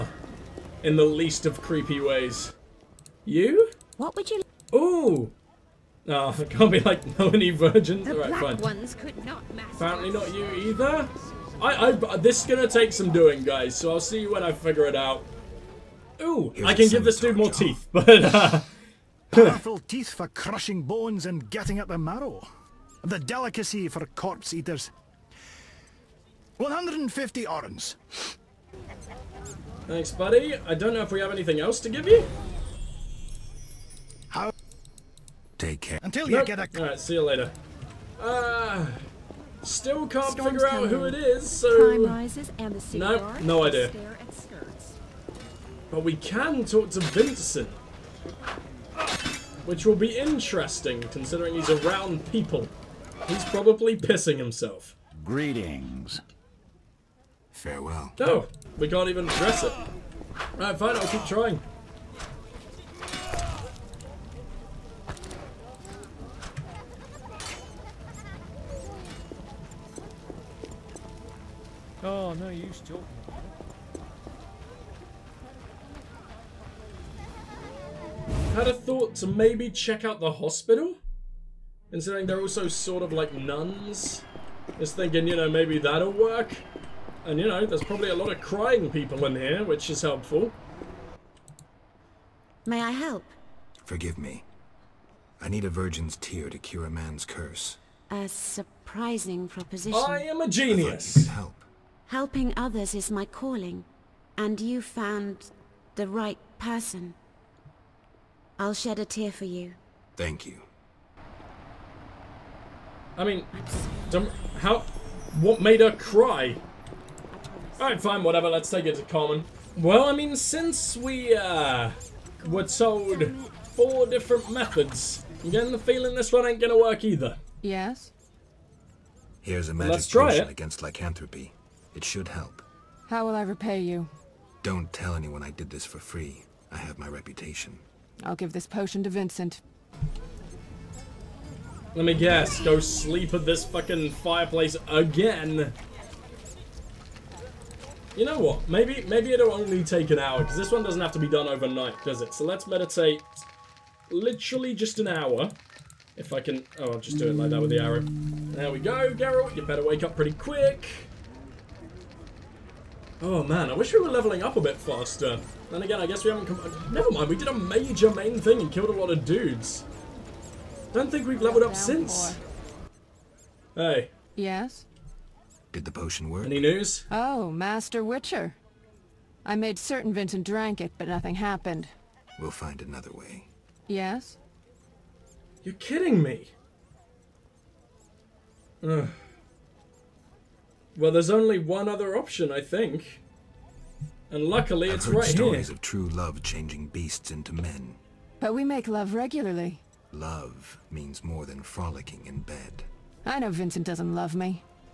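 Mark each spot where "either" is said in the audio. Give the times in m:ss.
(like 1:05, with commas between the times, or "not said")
0:10, 2:07.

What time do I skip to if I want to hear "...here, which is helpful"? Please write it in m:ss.
1:29.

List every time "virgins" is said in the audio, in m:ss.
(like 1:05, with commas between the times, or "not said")
0:07, 1:35.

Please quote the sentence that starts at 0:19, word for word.
Powerful teeth for crushing bones and getting at the marrow.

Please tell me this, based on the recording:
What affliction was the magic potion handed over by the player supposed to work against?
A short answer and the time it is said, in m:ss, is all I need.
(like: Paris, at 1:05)
Lycanthropy, at 2:10.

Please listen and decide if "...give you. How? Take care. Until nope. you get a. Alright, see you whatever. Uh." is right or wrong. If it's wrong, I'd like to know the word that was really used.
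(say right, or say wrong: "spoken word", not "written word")
wrong: "later", not "whatever".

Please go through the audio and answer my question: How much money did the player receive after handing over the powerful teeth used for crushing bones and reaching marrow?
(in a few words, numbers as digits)
150 orens.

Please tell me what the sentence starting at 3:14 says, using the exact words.
And luckily, I've it's heard right stories here.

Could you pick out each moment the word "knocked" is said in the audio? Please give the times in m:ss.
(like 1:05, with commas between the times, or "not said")
not said.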